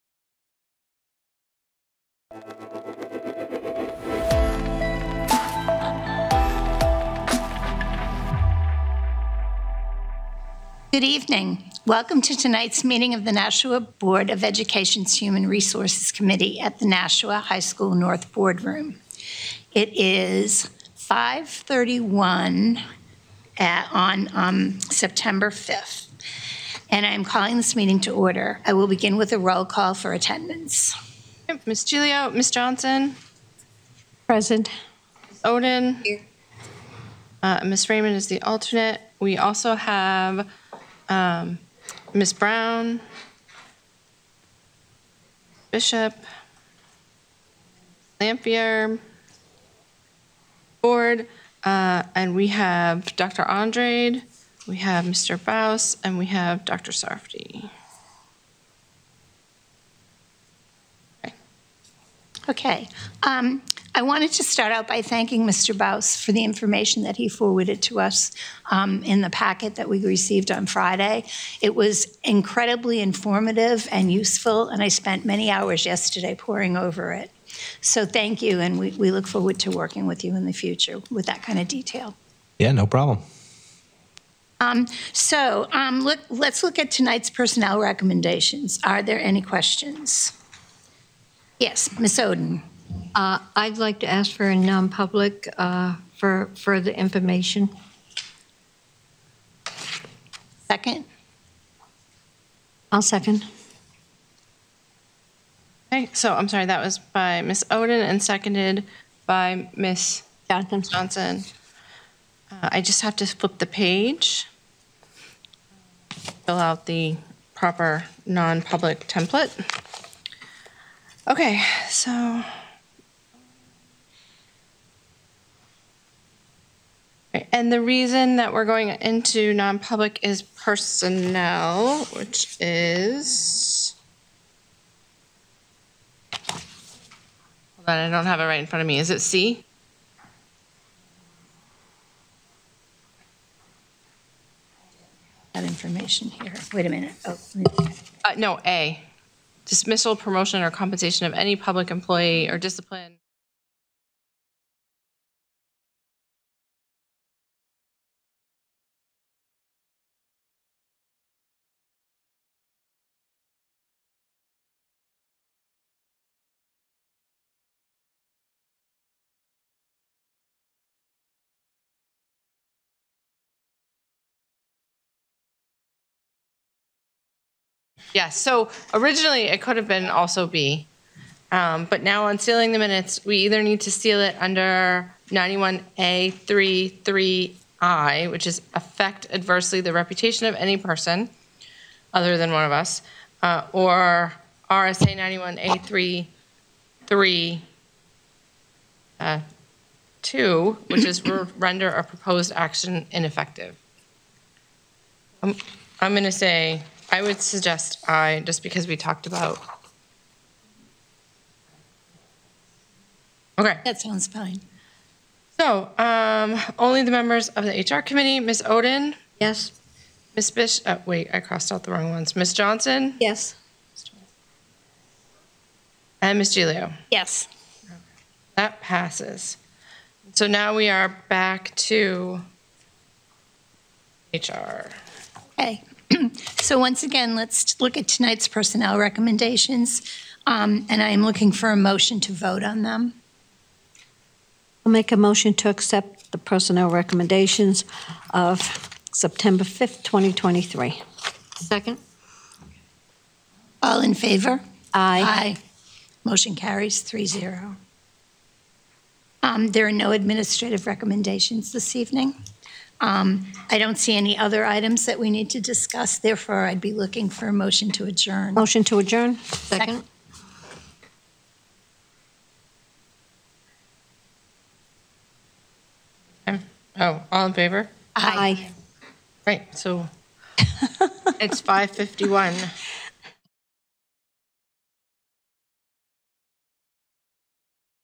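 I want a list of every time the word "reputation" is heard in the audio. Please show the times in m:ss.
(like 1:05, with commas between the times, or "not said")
3:09.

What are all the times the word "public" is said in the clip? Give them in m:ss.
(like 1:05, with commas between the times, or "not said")
1:34, 1:58, 2:09, 2:31.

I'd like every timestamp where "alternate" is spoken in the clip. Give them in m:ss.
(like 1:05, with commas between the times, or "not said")
0:38.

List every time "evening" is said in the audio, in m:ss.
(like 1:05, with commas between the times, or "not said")
0:11, 4:21.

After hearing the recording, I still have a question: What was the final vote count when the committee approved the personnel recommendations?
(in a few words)
3-0.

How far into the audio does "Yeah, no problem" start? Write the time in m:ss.
1:22.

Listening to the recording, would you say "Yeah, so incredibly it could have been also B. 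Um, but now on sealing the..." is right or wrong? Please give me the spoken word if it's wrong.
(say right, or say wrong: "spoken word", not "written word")
wrong: "originally", not "incredibly".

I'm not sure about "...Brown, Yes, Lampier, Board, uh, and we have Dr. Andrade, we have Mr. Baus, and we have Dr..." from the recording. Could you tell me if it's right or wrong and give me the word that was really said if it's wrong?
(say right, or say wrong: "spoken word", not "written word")
wrong: "Bishop", not "Yes".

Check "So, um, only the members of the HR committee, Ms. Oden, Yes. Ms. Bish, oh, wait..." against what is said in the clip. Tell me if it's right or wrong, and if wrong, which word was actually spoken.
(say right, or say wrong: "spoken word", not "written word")
right.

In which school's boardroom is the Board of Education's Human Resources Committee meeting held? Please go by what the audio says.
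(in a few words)
Nashua High School North.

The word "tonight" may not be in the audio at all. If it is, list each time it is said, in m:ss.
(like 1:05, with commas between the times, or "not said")
0:12, 1:26, 3:58.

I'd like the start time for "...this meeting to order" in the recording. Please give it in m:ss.
0:27.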